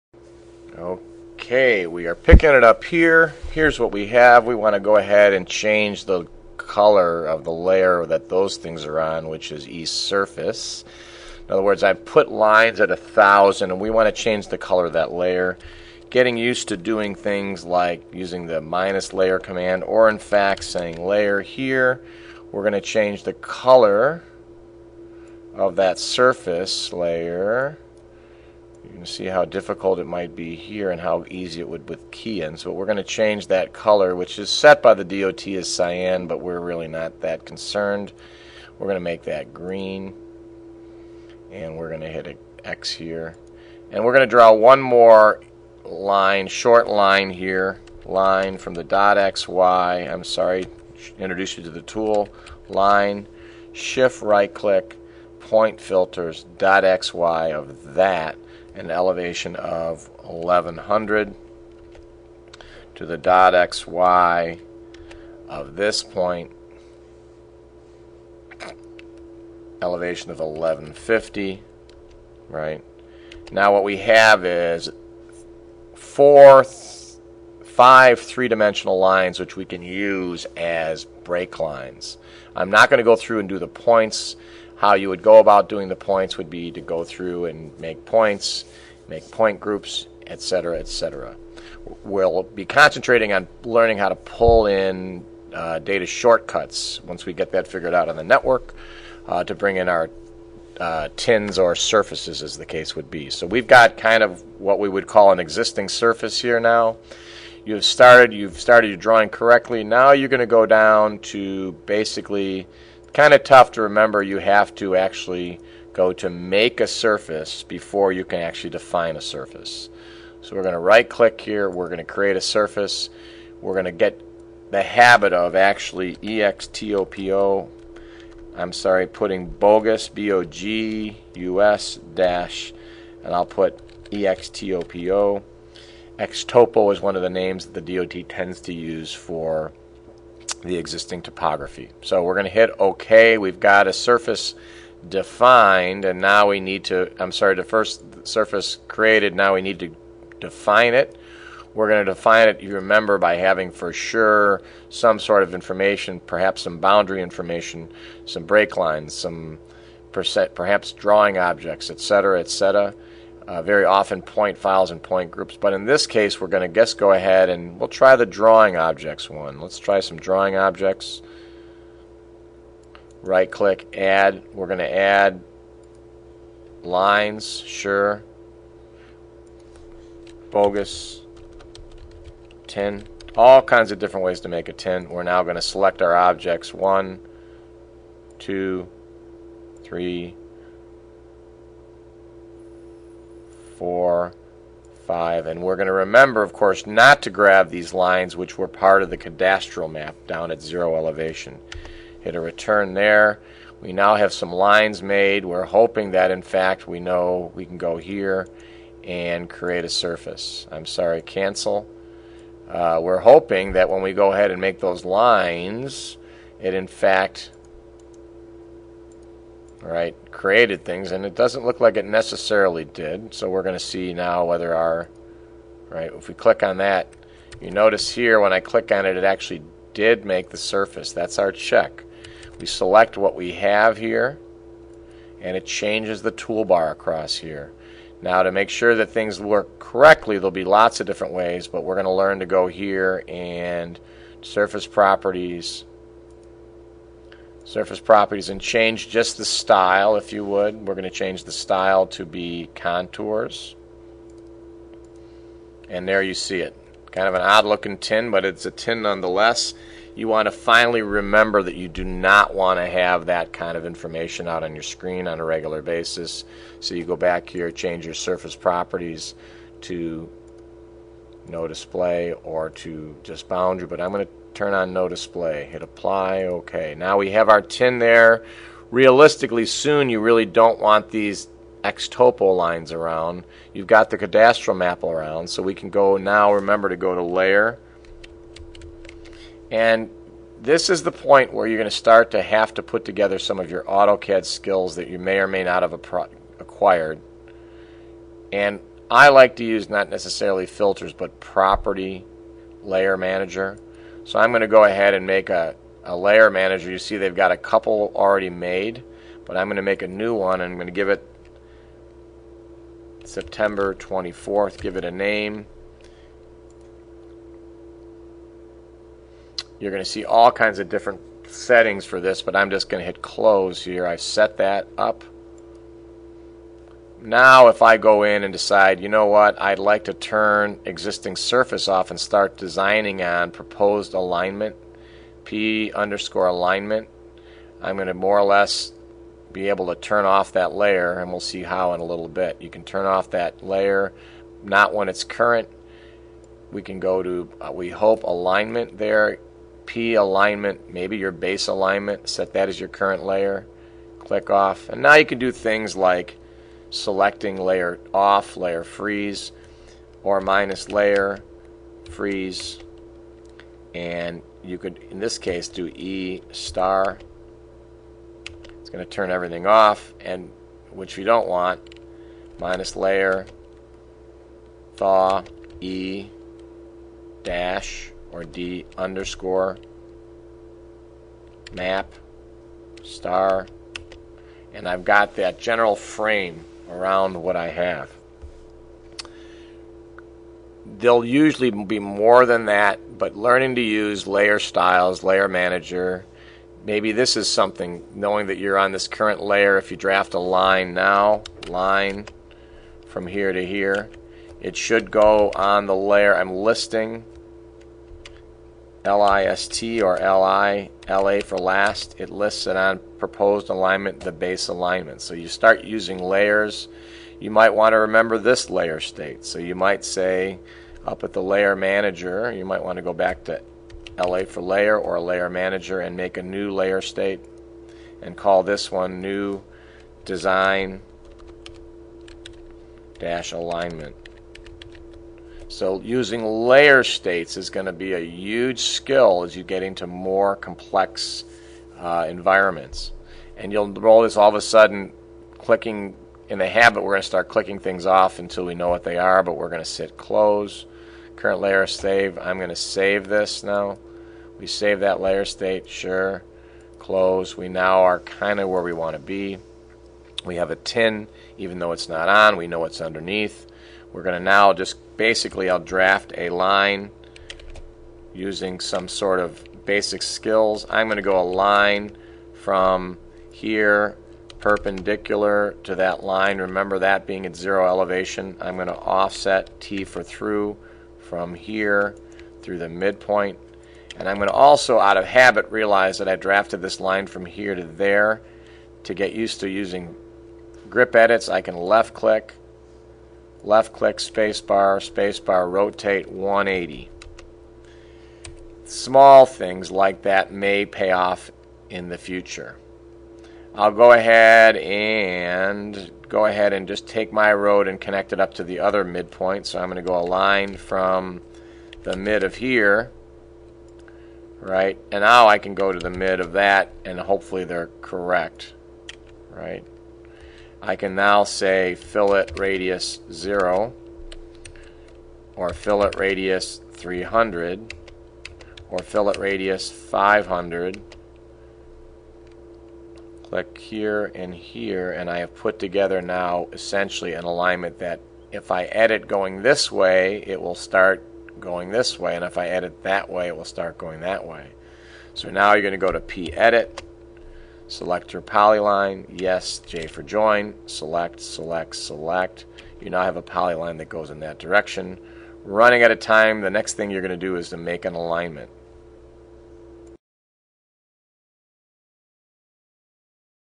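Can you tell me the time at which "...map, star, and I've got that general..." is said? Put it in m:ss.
6:21.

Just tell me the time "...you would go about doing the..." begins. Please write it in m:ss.
1:24.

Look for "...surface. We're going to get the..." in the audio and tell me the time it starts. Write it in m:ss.
2:02.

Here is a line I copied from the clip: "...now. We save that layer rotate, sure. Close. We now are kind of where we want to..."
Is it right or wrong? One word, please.
wrong.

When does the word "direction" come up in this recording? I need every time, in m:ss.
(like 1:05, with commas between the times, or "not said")
9:14.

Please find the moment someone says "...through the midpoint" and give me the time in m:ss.
8:02.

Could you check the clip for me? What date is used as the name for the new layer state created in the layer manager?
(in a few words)
September 24th.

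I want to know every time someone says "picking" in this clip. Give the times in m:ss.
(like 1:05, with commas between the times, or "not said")
0:02.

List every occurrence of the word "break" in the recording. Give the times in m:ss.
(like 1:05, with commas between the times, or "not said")
1:21, 2:38.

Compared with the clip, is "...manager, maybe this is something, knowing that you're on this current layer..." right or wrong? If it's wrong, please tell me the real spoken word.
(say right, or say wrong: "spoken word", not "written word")
right.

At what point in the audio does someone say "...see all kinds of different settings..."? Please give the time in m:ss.
5:20.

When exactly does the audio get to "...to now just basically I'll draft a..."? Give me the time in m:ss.
7:44.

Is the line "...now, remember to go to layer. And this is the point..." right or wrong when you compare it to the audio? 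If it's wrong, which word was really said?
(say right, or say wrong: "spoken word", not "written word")
right.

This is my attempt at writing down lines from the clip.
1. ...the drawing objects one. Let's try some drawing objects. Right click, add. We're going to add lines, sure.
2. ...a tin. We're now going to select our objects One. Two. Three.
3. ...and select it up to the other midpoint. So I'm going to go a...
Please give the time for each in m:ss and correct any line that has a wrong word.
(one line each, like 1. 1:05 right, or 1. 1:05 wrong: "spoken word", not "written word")
1. 2:48 right
2. 3:04 right
3. 8:27 wrong: "connect", not "select".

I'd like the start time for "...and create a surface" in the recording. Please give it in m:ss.
3:29.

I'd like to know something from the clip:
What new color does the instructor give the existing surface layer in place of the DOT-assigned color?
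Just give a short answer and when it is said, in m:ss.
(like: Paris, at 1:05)
green, at 0:39.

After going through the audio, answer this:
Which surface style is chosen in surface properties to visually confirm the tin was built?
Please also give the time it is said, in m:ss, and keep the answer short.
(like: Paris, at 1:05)
contours, at 4:12.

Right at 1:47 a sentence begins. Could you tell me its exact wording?
You've started, you've started your drawing correctly.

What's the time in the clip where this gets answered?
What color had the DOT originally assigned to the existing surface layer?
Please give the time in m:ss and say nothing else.
0:35.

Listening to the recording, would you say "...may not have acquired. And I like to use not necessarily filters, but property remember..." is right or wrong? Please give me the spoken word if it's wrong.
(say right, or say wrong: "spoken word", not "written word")
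wrong: "layer", not "remember".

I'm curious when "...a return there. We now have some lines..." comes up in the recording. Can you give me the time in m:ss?
3:22.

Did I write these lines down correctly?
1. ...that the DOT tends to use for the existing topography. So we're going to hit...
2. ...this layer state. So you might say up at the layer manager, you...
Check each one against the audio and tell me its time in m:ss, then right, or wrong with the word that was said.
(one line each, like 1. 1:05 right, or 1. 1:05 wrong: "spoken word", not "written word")
1. 2:17 right
2. 6:58 right.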